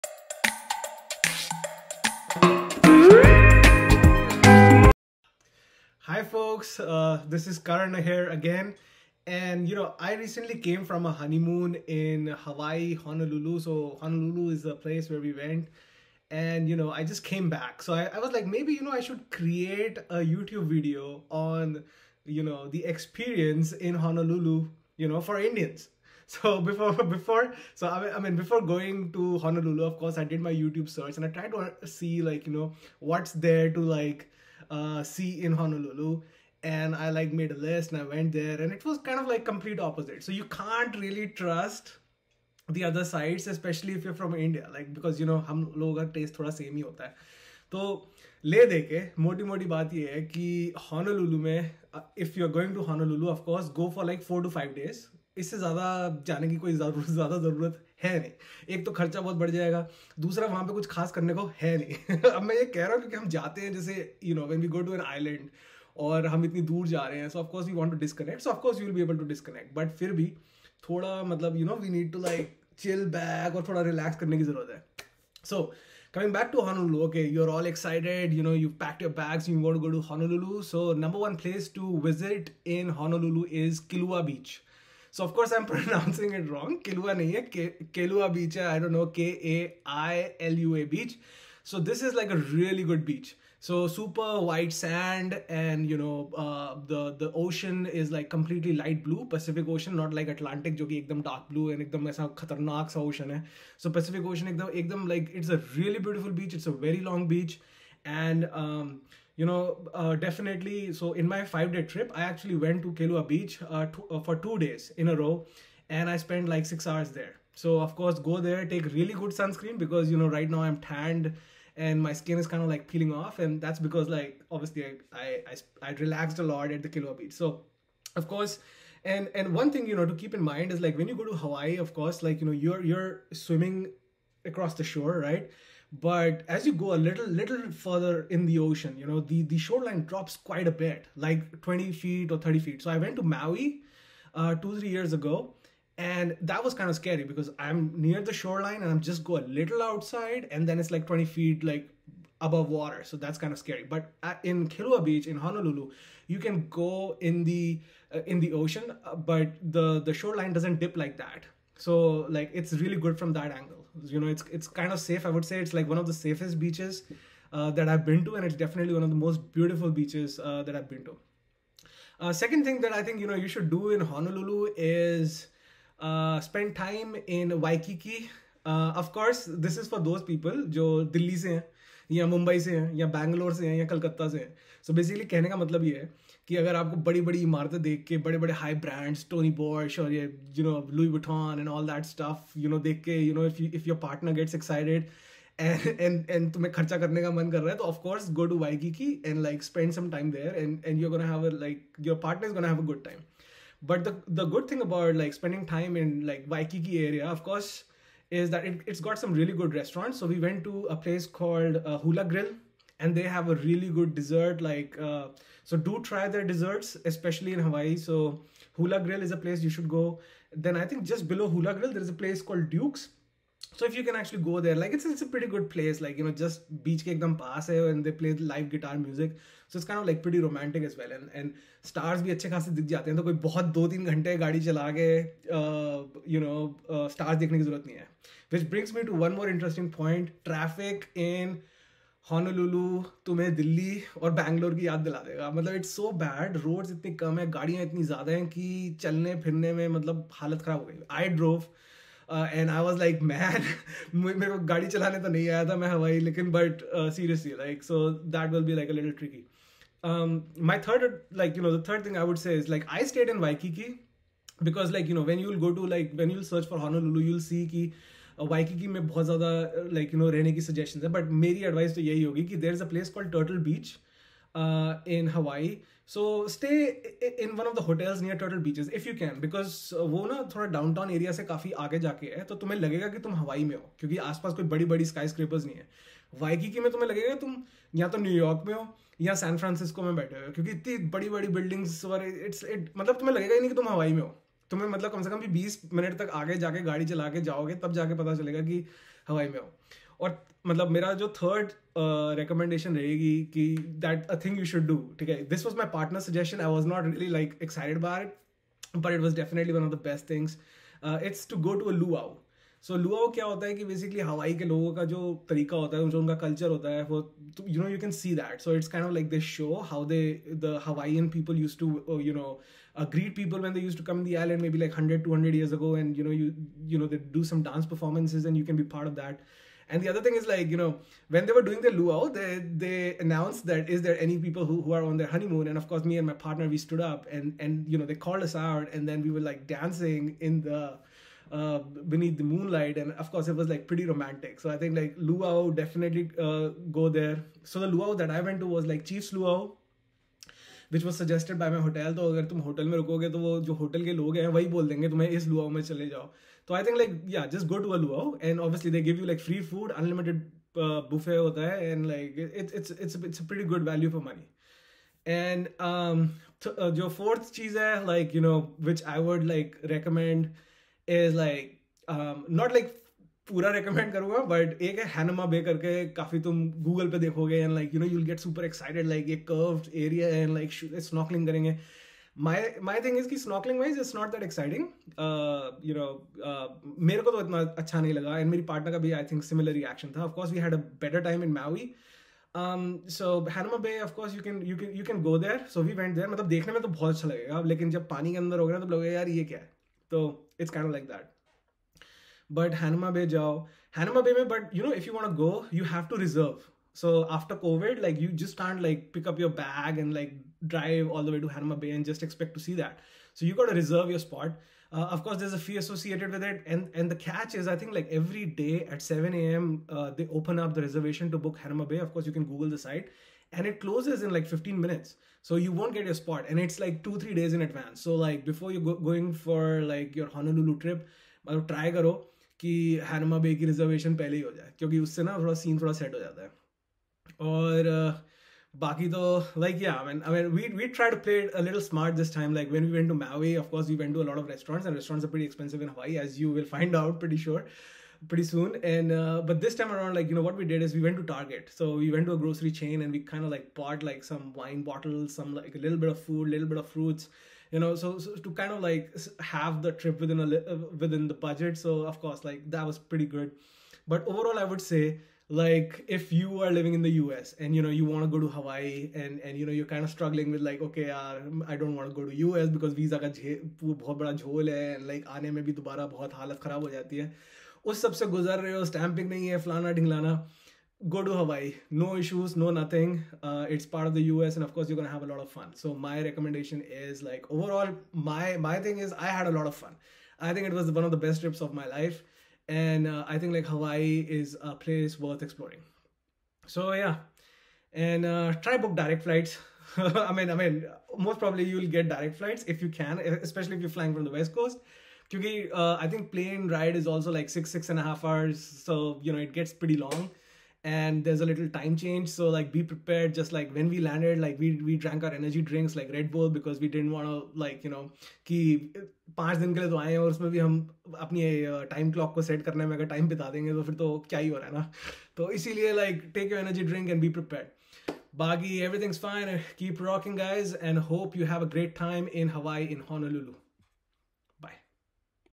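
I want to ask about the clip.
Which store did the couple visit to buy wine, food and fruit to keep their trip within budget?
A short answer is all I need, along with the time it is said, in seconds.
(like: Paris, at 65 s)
Target, at 451 s.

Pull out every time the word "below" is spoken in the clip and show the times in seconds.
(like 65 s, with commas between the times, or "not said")
221 s.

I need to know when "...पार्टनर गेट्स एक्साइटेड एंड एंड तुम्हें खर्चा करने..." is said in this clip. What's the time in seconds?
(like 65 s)
194 s.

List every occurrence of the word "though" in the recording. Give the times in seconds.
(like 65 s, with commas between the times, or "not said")
439 s.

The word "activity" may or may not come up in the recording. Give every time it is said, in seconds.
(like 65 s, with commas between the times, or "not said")
not said.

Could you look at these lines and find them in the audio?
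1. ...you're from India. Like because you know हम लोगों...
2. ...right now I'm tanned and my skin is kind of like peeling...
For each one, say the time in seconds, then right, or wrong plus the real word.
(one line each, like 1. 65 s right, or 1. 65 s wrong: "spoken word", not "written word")
1. 44 s right
2. 120 s right.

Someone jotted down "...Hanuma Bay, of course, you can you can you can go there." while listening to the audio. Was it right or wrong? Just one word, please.
right.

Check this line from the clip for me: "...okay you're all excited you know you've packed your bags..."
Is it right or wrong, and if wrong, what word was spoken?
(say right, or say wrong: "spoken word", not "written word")
right.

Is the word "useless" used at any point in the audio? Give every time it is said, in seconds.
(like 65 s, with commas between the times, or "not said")
not said.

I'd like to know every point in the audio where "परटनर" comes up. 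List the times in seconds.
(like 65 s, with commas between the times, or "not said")
194 s, 202 s, 305 s, 388 s.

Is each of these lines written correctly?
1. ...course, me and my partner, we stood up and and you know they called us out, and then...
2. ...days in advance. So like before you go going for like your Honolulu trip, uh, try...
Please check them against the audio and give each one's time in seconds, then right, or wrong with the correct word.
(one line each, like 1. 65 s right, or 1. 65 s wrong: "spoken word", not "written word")
1. 335 s right
2. 427 s right.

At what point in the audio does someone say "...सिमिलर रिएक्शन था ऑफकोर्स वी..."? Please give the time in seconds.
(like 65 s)
389 s.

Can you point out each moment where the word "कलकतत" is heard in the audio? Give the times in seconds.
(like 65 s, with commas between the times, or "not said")
183 s.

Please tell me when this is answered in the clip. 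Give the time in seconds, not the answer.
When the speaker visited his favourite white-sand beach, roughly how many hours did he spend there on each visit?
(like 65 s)
116 s.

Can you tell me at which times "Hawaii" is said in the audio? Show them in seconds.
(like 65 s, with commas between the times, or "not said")
12 s, 131 s, 217 s, 445 s, 468 s, 481 s, 493 s.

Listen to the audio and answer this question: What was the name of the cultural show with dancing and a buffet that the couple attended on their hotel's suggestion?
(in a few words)
Chiefs Luau.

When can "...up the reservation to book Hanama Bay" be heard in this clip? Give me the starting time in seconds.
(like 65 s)
420 s.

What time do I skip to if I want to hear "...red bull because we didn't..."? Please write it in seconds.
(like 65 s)
516 s.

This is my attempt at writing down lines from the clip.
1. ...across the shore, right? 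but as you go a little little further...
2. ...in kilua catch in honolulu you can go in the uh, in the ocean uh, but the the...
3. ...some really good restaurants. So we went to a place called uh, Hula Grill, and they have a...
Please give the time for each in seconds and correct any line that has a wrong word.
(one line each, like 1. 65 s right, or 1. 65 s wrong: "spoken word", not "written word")
1. 134 s right
2. 154 s wrong: "beach", not "catch"
3. 209 s right.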